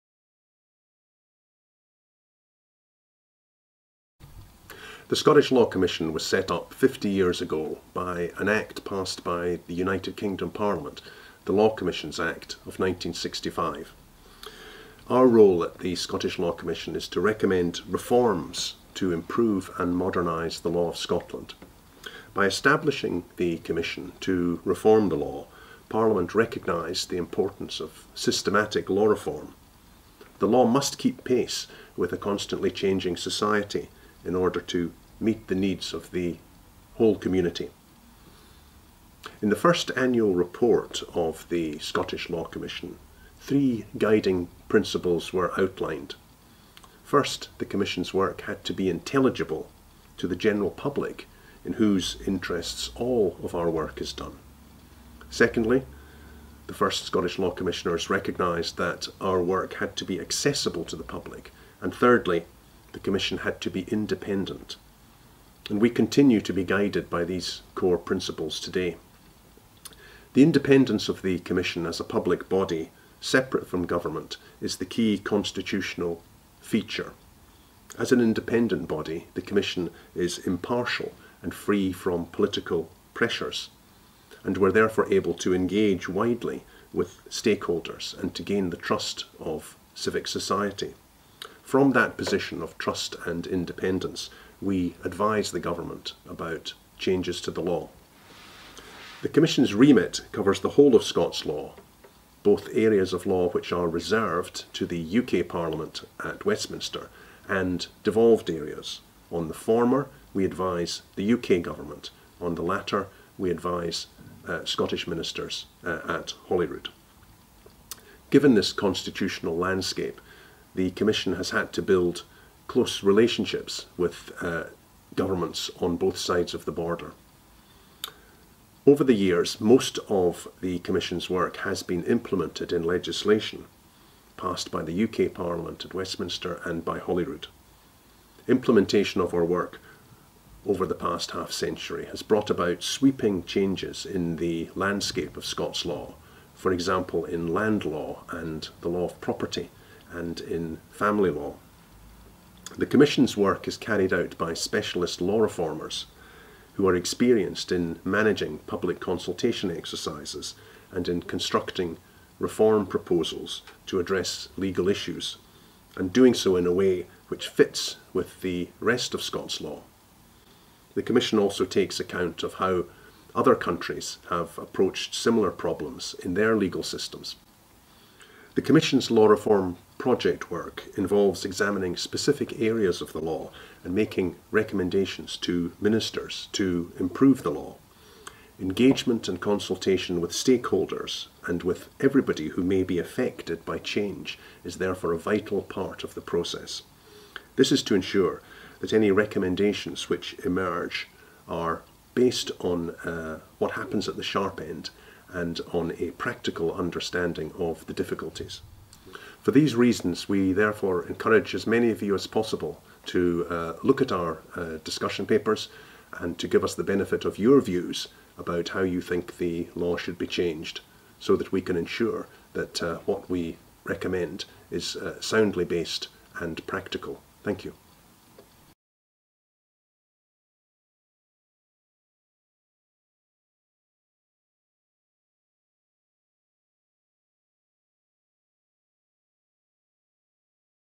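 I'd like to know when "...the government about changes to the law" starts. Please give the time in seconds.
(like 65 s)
95 s.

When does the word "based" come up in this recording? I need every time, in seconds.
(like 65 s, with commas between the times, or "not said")
202 s, 225 s.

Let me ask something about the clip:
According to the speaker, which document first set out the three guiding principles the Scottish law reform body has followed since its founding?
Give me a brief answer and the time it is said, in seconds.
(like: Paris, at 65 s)
first annual report, at 39 s.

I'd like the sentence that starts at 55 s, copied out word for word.
Secondly, the first Scottish Law Commissioners recognised that our work had to be accessible to the public.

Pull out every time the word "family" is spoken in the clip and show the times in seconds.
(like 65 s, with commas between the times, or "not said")
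150 s.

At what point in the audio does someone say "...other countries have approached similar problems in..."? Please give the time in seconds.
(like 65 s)
173 s.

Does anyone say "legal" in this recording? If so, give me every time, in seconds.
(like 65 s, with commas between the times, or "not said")
164 s, 176 s.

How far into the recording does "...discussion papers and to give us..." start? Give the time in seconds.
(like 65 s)
214 s.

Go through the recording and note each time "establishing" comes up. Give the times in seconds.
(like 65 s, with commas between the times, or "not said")
22 s.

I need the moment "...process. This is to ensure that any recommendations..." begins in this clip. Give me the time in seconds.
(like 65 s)
196 s.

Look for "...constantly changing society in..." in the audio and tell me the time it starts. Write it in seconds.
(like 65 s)
32 s.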